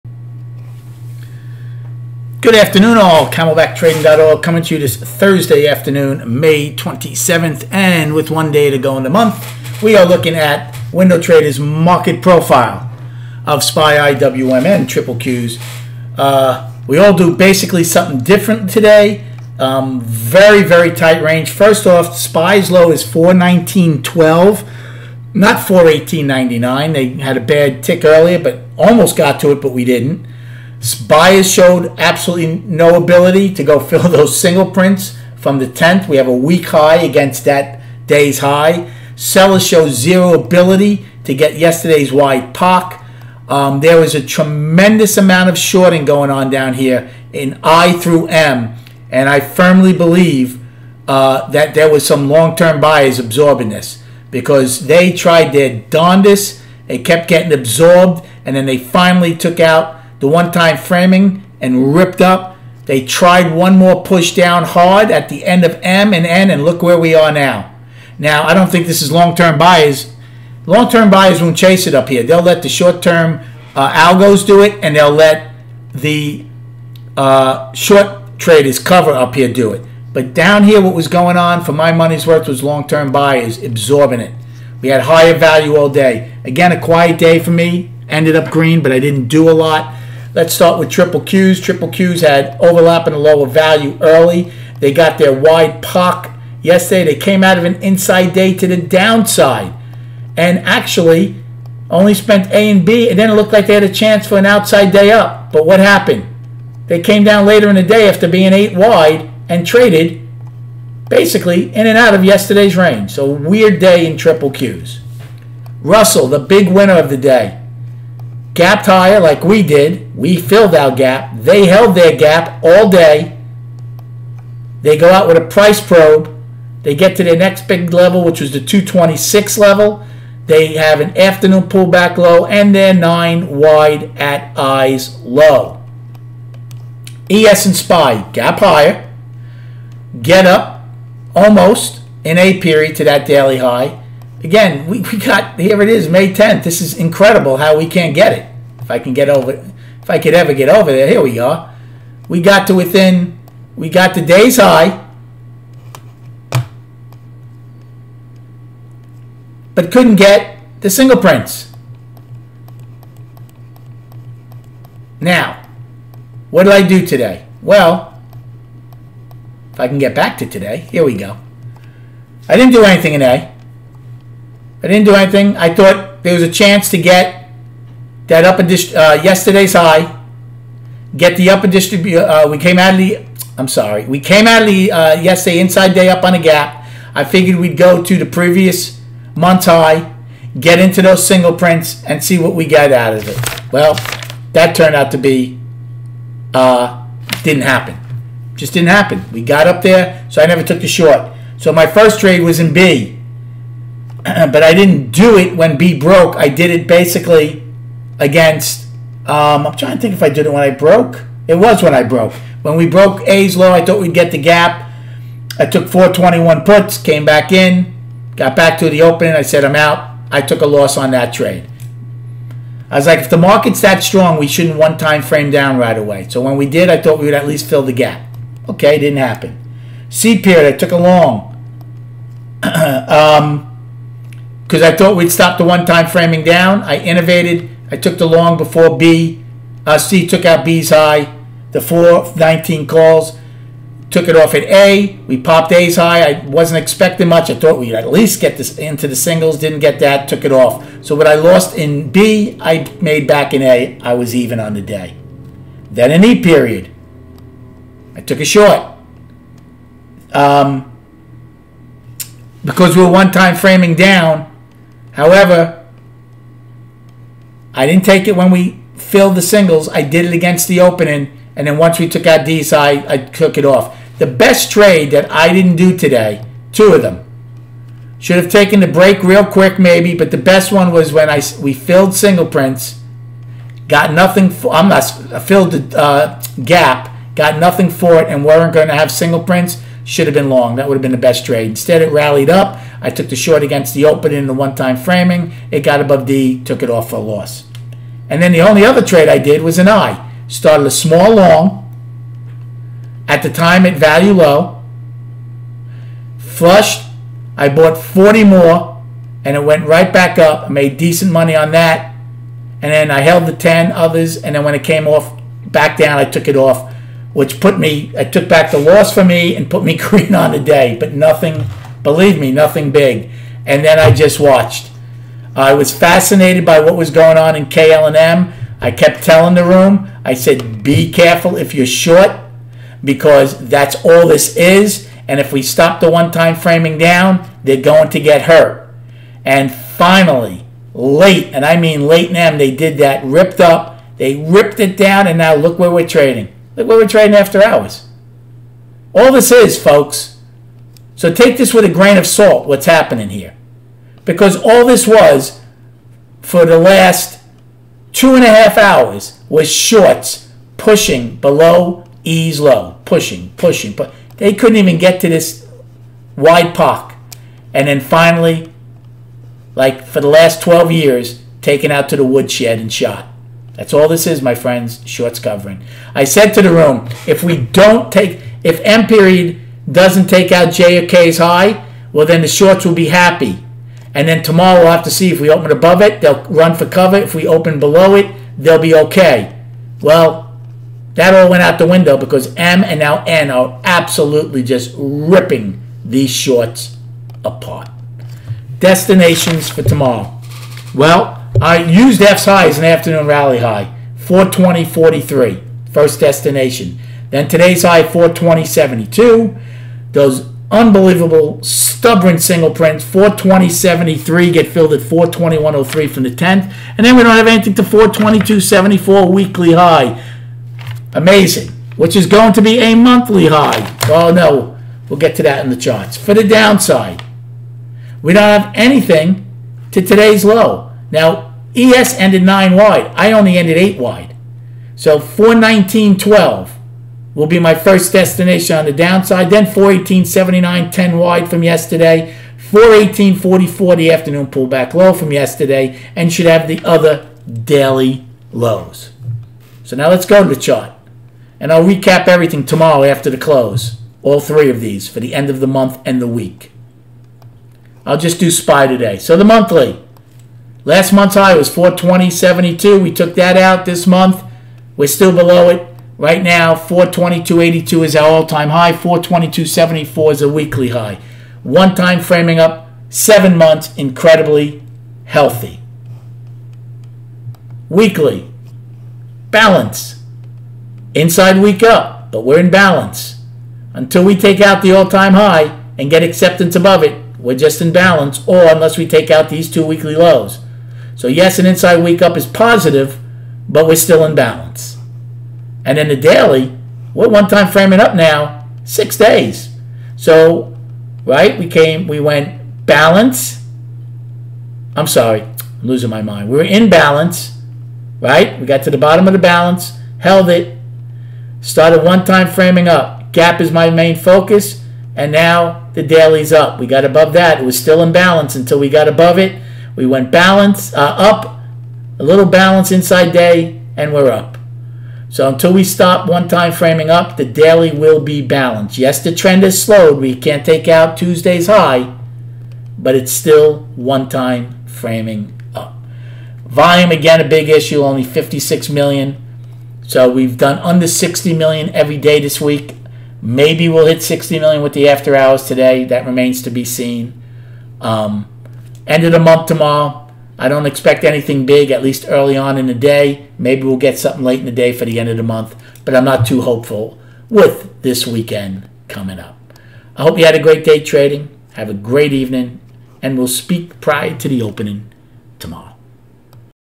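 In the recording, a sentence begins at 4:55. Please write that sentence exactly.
It got above D, took it off for a loss.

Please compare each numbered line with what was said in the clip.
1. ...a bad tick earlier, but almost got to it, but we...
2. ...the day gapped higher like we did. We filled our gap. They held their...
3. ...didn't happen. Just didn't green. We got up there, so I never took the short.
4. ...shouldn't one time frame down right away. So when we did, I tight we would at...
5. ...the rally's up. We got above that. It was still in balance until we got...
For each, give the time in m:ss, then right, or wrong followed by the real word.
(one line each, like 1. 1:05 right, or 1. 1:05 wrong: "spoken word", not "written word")
1. 0:27 right
2. 1:57 right
3. 3:17 wrong: "happen", not "green"
4. 3:44 wrong: "thought", not "tight"
5. 8:35 wrong: "daily", not "rally".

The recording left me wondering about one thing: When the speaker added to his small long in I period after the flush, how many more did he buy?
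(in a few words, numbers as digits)
40.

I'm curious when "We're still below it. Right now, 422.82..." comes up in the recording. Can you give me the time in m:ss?
7:44.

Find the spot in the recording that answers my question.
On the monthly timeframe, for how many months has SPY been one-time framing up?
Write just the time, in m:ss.
7:53.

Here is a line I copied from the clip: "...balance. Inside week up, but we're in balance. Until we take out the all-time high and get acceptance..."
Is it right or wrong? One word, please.
right.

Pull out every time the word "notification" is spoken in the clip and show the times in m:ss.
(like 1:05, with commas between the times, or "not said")
not said.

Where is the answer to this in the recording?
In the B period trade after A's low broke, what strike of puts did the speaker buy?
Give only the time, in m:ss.
3:35.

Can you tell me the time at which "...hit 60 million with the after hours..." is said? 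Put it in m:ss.
9:04.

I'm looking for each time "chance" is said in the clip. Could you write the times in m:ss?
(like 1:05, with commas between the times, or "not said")
1:43, 2:56.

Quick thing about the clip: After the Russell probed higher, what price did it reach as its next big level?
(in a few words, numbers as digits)
226.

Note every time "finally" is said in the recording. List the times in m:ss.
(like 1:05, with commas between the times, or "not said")
0:58, 5:39, 6:07.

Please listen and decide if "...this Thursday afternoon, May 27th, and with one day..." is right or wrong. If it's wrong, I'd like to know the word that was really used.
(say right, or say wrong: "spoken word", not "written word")
right.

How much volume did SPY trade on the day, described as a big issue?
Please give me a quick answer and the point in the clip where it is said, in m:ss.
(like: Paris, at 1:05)
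56 million, at 8:58.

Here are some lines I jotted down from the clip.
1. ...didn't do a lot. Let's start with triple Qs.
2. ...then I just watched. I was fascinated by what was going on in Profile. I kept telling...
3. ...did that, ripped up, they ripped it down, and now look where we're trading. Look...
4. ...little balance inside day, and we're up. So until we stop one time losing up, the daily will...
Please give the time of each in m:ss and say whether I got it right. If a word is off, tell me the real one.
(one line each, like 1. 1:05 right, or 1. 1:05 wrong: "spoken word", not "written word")
1. 1:28 right
2. 5:23 wrong: "KLM", not "Profile"
3. 5:42 right
4. 8:42 wrong: "framing", not "losing".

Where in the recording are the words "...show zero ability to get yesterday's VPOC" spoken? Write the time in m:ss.
0:39.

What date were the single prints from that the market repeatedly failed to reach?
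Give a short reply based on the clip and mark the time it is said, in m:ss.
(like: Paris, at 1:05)
May 10th, at 2:26.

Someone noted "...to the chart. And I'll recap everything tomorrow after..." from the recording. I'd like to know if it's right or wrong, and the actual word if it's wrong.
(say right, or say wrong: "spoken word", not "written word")
right.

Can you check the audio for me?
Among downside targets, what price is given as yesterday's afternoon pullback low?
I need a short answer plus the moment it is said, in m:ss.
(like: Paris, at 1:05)
418.44, at 7:22.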